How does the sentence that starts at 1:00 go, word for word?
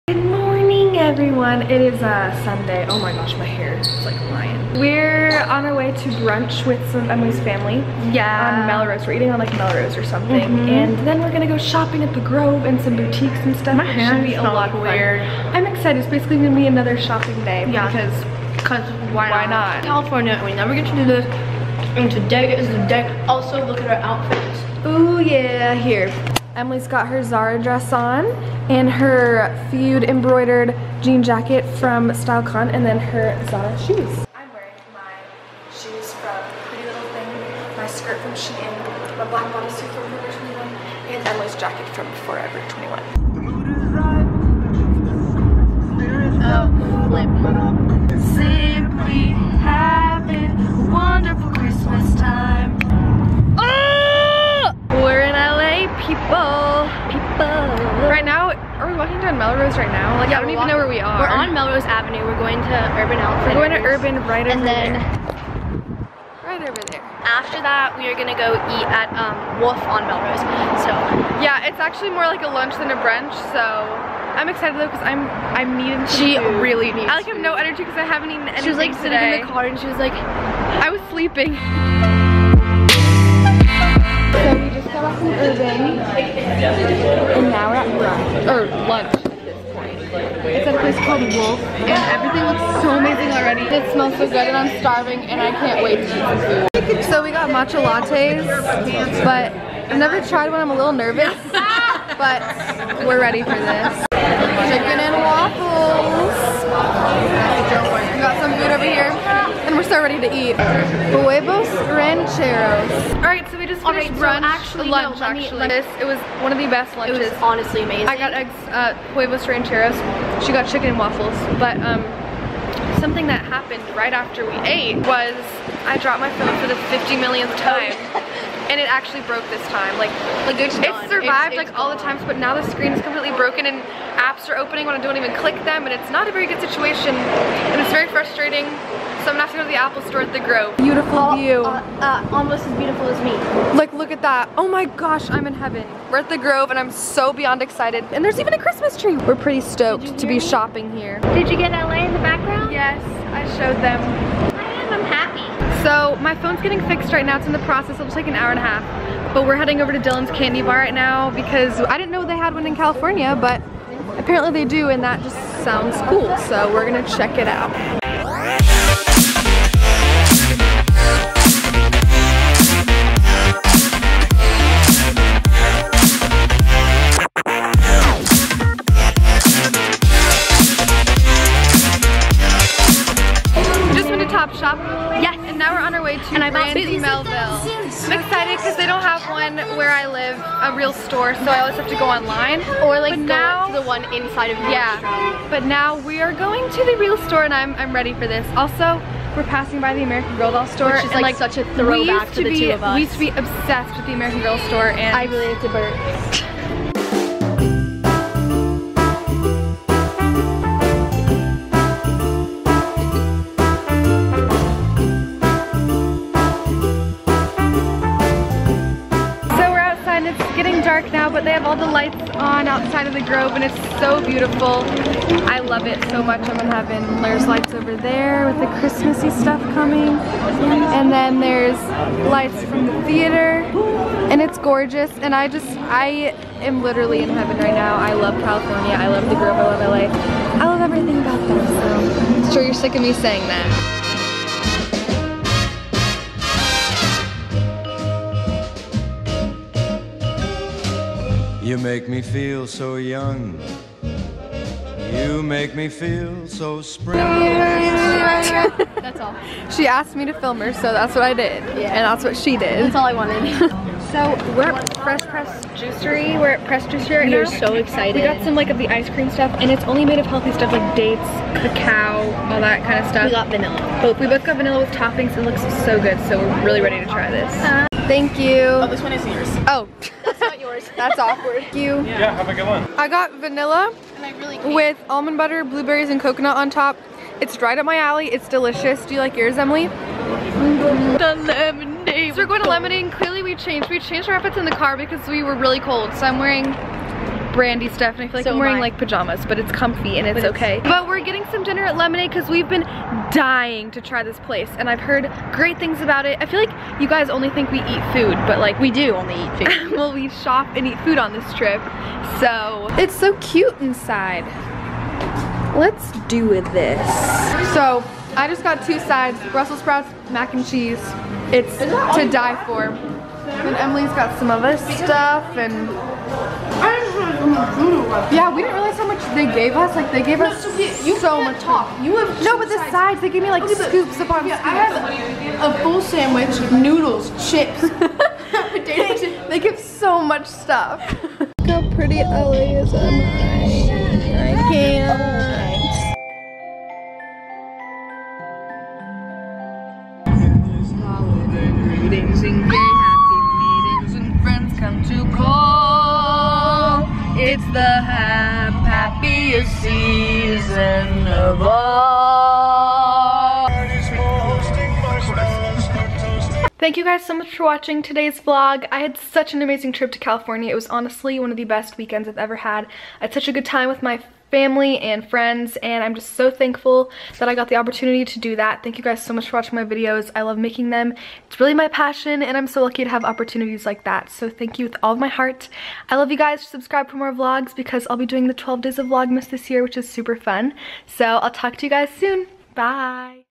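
Like, yeah, I don't even know where we are.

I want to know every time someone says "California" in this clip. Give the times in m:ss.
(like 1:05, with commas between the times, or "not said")
0:19, 2:42, 3:58, 6:10.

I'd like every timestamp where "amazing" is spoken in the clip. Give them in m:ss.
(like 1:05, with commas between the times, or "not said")
1:32, 1:57, 6:09.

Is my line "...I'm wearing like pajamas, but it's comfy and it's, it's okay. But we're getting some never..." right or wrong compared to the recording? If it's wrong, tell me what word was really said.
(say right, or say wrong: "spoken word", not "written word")
wrong: "dinner", not "never".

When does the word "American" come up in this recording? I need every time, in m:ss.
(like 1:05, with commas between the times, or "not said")
3:20, 3:24.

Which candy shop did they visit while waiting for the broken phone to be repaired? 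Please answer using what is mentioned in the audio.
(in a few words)
Dylan's Candy Bar.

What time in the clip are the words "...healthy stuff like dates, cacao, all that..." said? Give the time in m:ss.
4:30.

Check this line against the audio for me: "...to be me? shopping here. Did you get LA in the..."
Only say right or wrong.
right.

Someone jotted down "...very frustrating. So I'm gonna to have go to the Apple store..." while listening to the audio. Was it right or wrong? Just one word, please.
right.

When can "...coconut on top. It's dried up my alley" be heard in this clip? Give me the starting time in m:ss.
4:46.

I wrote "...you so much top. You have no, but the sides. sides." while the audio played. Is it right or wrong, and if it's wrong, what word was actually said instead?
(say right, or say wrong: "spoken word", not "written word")
right.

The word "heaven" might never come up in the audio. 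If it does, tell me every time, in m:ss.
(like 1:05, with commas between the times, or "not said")
2:25, 3:46, 3:57.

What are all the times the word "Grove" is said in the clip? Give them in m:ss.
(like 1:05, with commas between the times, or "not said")
0:12, 2:20, 2:26, 3:43, 3:59.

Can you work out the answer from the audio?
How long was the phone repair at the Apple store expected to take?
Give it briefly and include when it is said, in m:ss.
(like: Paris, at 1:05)
An hour and a half, at 2:38.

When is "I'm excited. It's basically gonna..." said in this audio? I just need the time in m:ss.
0:15.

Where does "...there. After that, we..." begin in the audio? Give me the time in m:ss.
1:06.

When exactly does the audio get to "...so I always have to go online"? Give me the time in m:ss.
3:11.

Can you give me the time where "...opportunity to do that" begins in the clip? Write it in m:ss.
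6:17.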